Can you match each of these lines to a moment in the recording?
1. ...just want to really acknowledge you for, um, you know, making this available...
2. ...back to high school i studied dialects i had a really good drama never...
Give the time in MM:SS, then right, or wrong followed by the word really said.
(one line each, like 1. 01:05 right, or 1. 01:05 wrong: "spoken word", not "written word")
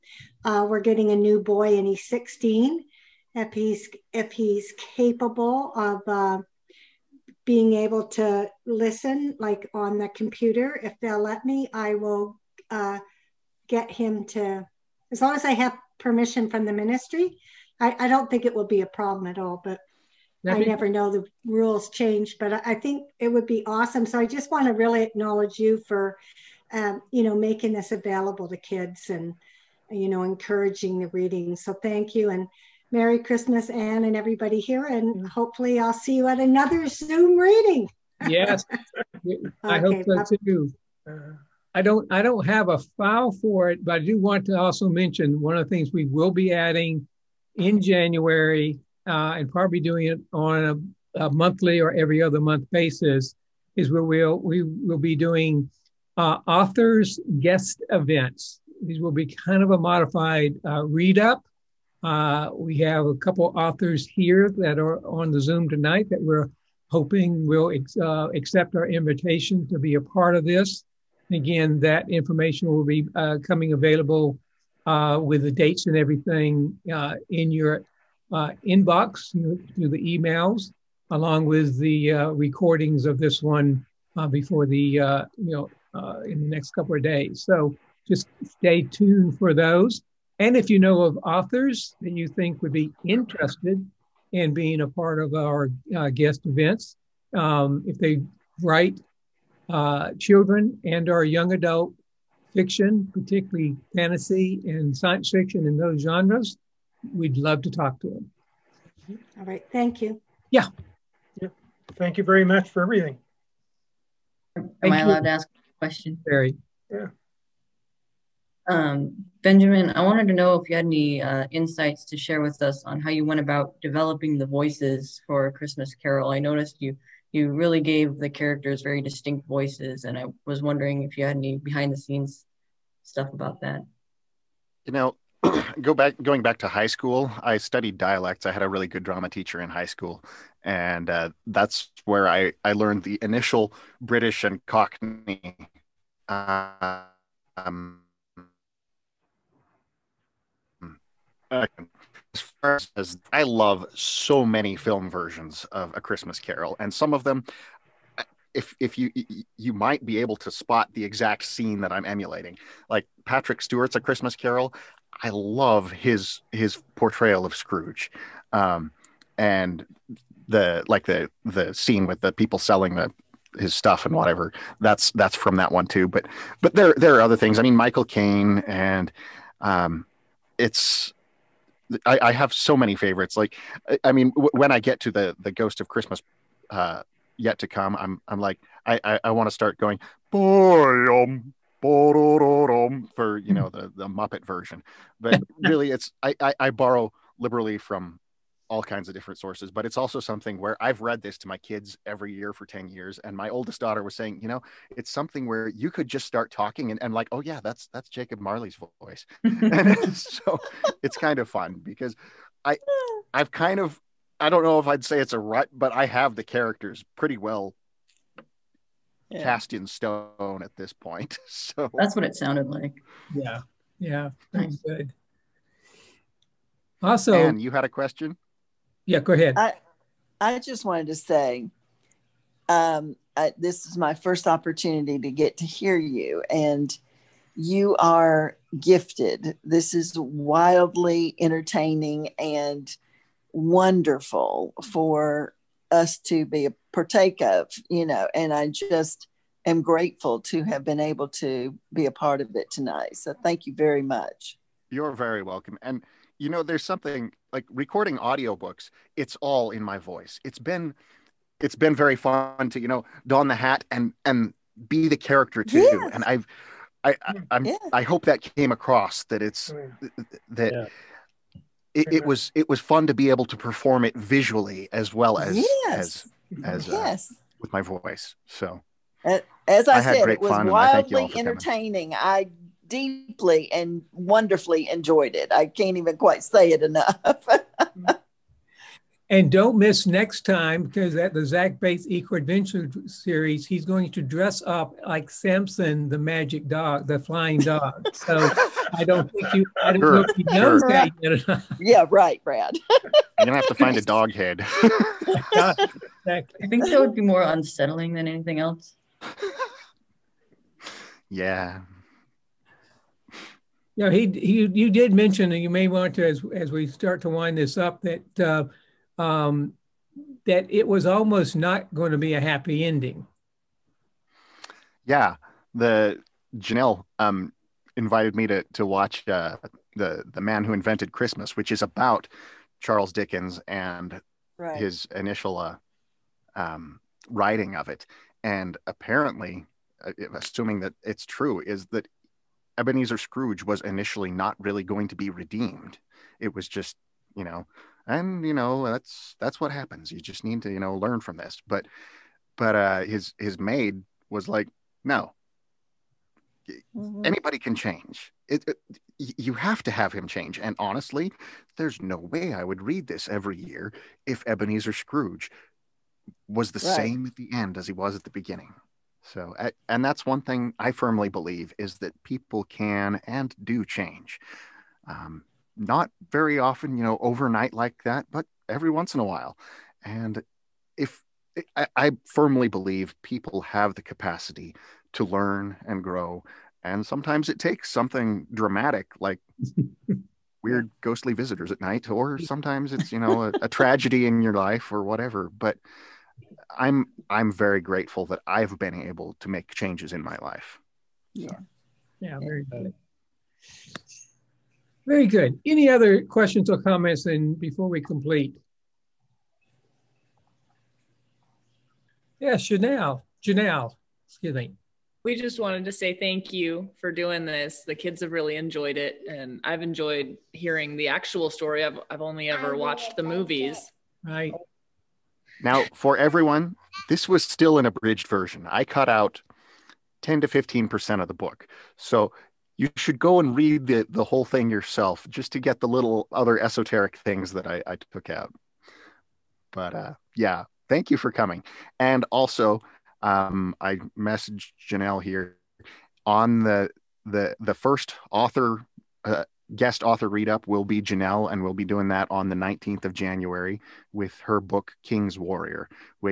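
1. 00:24 right
2. 02:16 wrong: "teacher", not "never".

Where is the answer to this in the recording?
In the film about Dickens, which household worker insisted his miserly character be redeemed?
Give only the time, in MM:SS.
05:53.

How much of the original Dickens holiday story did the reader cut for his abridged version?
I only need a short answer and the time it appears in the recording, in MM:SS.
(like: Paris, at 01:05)
10 to 15%, at 07:10.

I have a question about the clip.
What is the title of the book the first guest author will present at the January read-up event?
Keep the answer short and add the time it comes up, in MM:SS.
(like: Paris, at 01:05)
King's Warrior, at 07:35.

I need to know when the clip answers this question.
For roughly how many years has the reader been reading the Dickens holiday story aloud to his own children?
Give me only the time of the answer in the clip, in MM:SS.
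03:22.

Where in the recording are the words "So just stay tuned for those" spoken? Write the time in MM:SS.
01:27.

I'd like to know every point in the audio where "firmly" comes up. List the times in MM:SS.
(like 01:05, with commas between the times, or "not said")
06:10, 06:22.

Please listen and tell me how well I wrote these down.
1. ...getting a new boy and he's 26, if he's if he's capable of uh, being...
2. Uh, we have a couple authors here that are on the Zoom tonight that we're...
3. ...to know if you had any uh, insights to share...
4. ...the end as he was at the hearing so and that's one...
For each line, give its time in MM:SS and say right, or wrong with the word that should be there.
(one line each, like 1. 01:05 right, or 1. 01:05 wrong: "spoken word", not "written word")
1. 00:00 wrong: "16", not "26"
2. 01:02 right
3. 02:00 right
4. 06:07 wrong: "beginning", not "hearing".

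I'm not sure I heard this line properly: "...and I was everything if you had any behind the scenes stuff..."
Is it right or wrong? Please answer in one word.
wrong.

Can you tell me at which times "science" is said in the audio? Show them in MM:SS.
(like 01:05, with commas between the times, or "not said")
01:44.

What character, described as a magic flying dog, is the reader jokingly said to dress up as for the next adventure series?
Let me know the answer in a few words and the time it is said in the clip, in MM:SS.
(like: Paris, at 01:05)
Samson, at 04:55.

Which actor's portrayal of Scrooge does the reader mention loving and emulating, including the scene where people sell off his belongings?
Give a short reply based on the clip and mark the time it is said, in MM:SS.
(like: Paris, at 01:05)
Patrick Stewart, at 02:43.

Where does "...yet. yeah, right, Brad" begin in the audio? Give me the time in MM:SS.
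05:01.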